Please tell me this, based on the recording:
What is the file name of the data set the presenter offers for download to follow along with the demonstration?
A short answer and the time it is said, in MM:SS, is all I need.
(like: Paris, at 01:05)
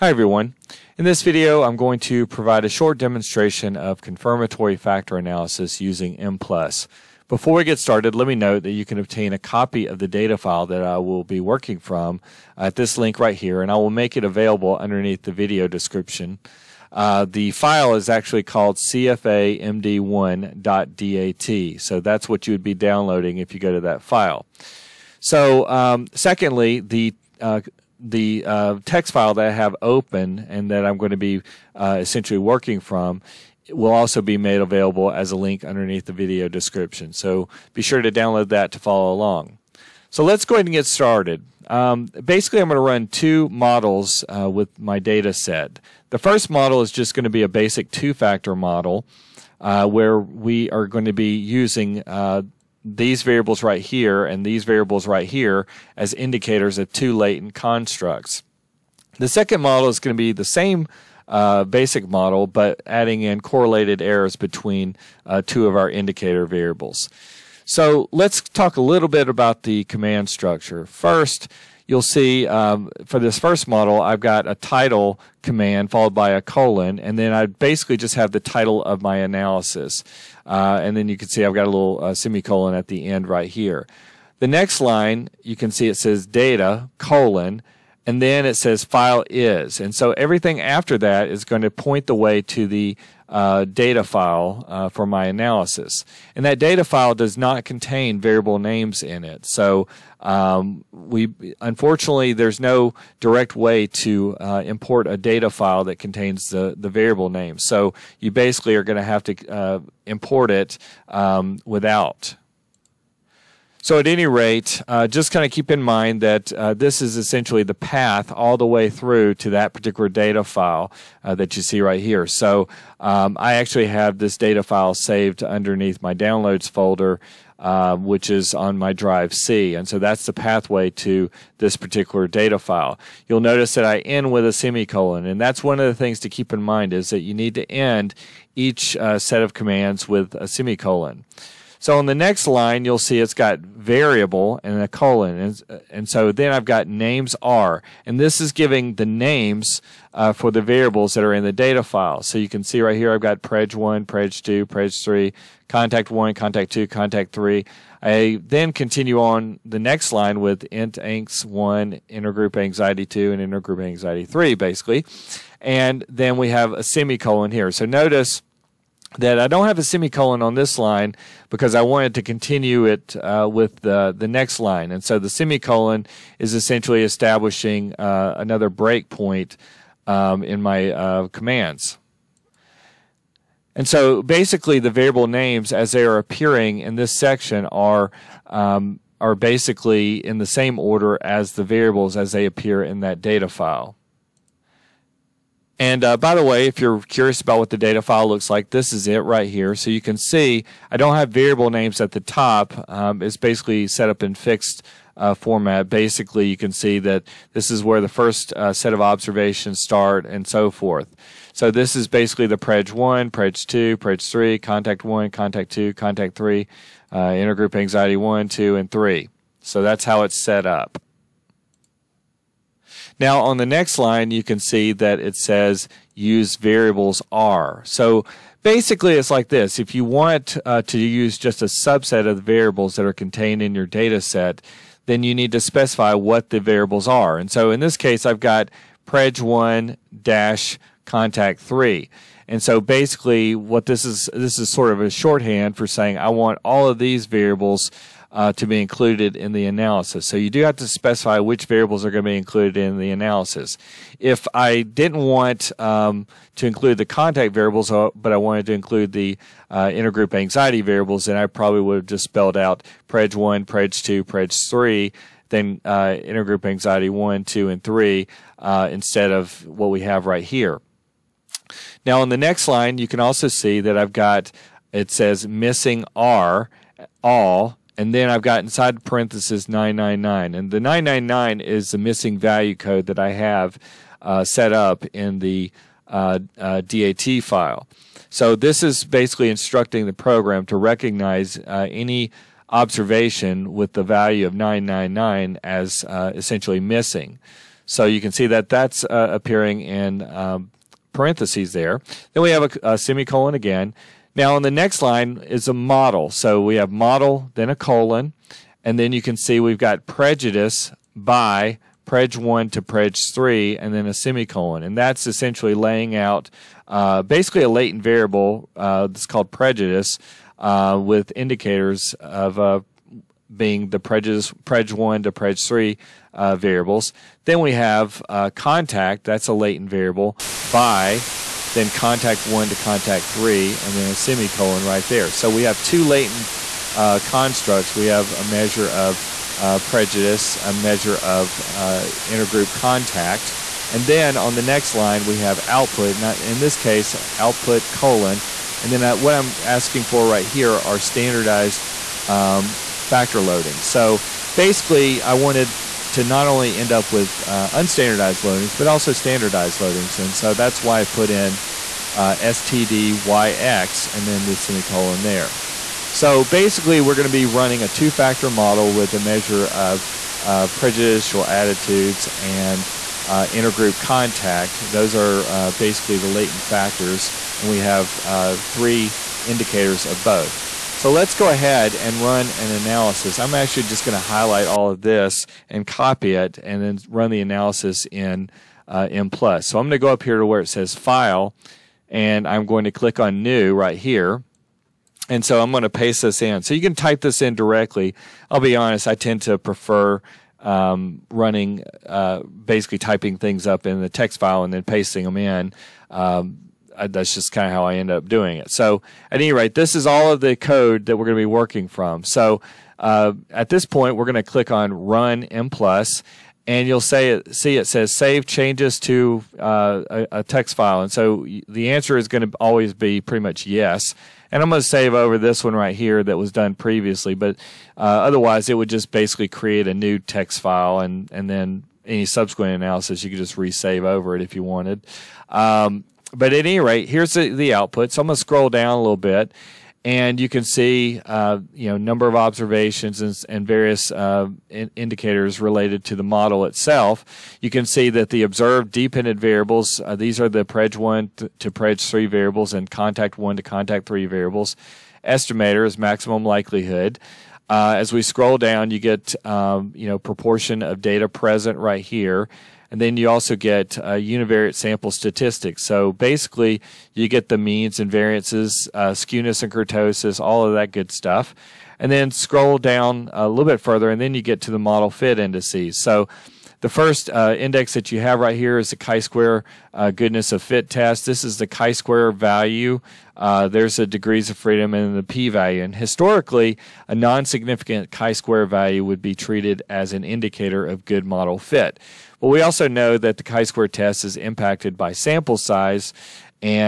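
cfamd1.dat, at 00:18.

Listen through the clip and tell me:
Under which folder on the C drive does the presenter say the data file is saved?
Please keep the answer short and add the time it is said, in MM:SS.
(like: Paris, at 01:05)
downloads folder, at 02:06.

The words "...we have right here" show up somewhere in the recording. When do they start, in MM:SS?
04:29.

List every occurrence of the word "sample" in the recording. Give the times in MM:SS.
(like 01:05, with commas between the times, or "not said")
07:44, 08:15.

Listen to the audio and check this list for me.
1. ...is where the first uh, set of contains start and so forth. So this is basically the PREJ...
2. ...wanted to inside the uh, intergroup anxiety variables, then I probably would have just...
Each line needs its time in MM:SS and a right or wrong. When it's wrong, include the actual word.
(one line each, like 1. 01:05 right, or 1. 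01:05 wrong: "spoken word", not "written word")
1. 03:27 wrong: "observations", not "contains"
2. 04:18 wrong: "include", not "inside".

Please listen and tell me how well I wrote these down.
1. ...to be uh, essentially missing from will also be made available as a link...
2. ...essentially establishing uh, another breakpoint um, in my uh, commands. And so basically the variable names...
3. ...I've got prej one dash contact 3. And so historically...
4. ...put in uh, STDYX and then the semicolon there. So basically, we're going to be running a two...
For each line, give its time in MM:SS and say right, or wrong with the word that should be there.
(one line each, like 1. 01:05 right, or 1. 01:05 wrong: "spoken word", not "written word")
1. 00:31 wrong: "working", not "missing"
2. 02:56 right
3. 03:58 wrong: "basically", not "historically"
4. 06:01 right.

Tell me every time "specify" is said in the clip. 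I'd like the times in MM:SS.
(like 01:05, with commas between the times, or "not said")
03:55, 04:10.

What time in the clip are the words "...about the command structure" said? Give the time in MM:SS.
01:09.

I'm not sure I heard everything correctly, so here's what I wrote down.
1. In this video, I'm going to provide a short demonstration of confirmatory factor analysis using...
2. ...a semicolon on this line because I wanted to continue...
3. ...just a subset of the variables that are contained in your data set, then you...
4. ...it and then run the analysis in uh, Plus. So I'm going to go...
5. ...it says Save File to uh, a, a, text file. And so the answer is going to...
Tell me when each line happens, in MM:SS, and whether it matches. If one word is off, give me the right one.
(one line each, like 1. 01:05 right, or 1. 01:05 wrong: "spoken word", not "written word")
1. 00:00 right
2. 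02:49 right
3. 03:51 right
4. 06:26 right
5. 06:57 wrong: "Changes", not "File".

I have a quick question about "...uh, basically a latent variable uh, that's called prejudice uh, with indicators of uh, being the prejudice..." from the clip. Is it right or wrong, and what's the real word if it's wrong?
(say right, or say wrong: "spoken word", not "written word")
right.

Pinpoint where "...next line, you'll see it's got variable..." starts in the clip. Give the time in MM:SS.
02:22.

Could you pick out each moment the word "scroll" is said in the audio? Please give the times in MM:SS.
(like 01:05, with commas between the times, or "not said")
07:18, 07:38, 07:52.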